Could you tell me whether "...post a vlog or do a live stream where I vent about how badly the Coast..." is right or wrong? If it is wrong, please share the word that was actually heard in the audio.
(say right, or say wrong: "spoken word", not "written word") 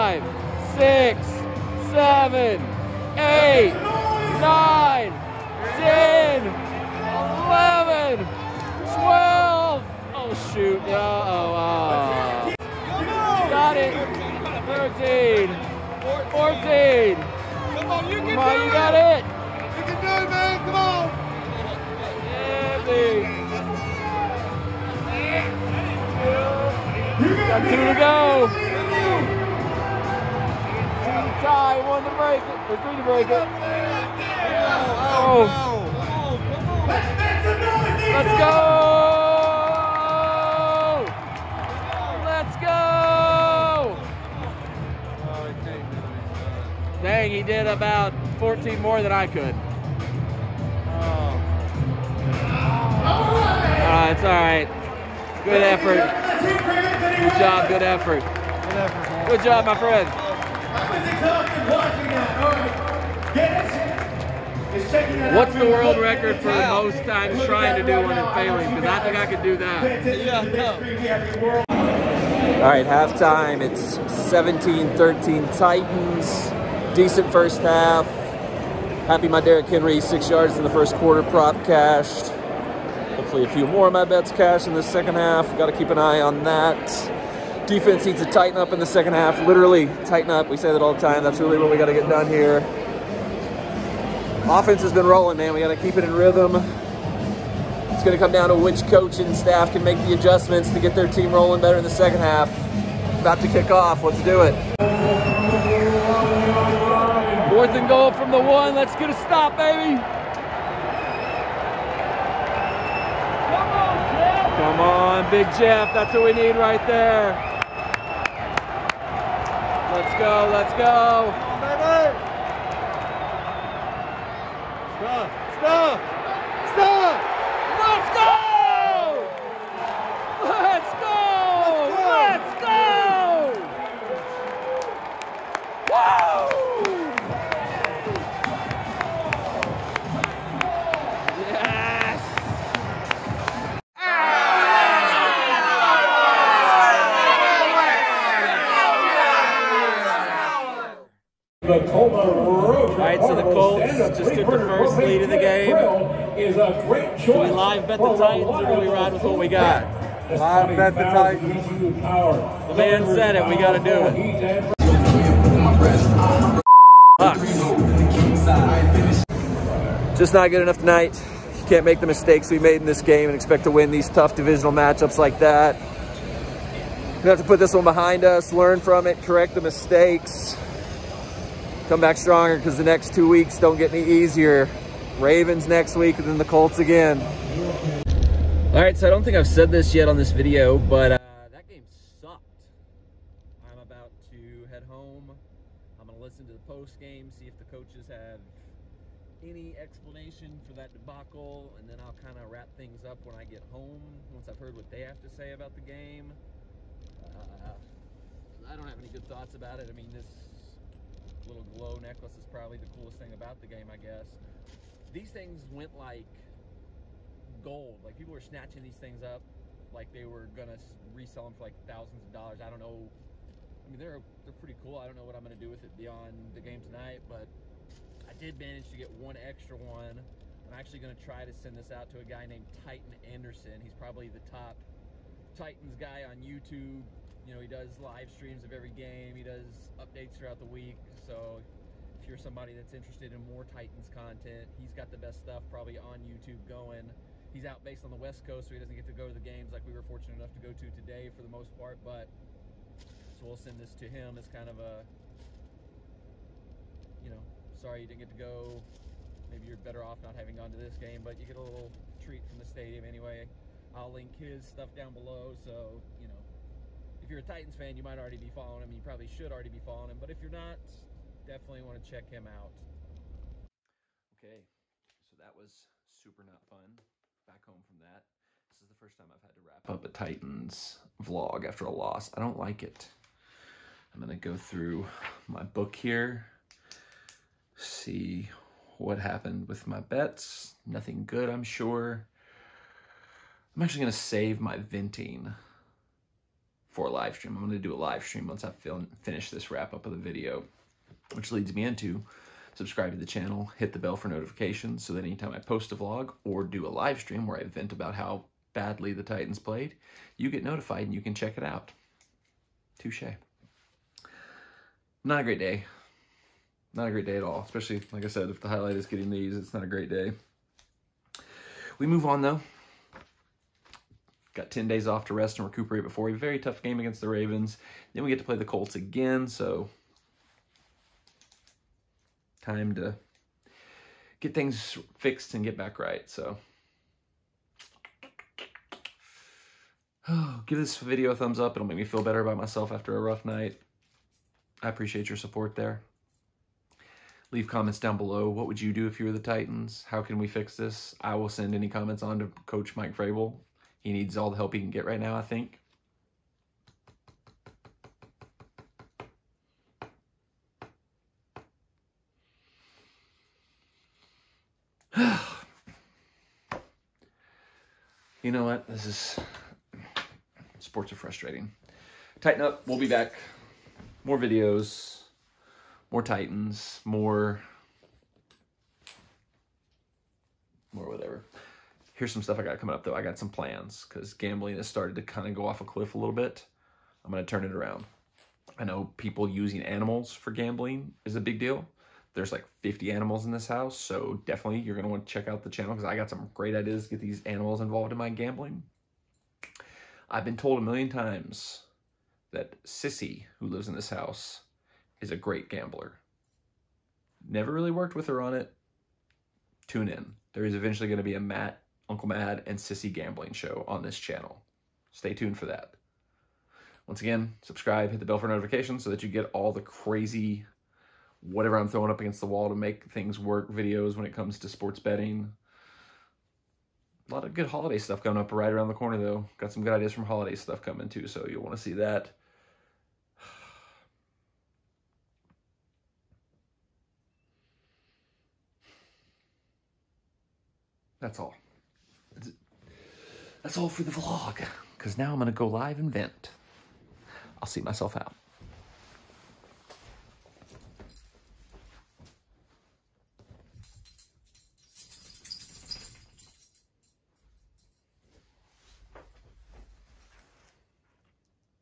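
wrong: "Titans", not "Coast".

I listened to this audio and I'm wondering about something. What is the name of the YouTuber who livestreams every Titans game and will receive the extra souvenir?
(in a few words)
Titan Anderson.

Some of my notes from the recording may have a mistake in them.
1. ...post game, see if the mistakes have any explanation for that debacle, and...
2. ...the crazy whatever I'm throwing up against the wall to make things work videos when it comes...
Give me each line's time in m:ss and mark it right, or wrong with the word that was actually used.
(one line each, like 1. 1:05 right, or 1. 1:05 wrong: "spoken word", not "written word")
1. 3:16 wrong: "coaches", not "mistakes"
2. 6:59 right.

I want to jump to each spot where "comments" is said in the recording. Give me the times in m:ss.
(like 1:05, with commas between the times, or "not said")
5:47, 5:51.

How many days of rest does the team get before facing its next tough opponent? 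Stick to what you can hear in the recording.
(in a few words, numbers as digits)
10.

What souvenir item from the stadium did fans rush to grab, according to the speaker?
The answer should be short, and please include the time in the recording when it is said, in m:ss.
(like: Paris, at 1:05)
glow necklace, at 3:31.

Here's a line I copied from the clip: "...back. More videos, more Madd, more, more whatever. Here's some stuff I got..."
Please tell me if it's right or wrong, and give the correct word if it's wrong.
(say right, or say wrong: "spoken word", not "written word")
wrong: "Titans", not "Madd".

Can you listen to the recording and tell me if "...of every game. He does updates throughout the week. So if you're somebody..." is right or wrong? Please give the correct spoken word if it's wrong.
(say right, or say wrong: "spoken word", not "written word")
right.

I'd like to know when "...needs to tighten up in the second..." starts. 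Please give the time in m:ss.
1:28.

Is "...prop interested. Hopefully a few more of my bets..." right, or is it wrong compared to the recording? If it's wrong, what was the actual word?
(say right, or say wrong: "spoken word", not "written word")
wrong: "cashed", not "interested".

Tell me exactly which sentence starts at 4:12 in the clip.
But so we'll send this to him as kind of a, you know, sorry you didn't get to go.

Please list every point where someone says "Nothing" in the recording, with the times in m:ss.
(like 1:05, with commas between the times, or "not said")
4:50.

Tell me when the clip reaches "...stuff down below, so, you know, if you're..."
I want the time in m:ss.
4:24.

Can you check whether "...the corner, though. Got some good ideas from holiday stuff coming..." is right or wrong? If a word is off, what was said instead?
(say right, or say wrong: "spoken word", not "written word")
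right.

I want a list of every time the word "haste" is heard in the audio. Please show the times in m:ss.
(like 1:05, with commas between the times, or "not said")
not said.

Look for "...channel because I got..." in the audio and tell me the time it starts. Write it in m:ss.
6:35.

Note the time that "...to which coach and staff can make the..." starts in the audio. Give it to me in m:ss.
1:38.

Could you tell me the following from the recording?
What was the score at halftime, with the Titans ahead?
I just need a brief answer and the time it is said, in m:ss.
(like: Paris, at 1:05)
17-13, at 1:14.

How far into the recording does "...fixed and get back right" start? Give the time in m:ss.
5:35.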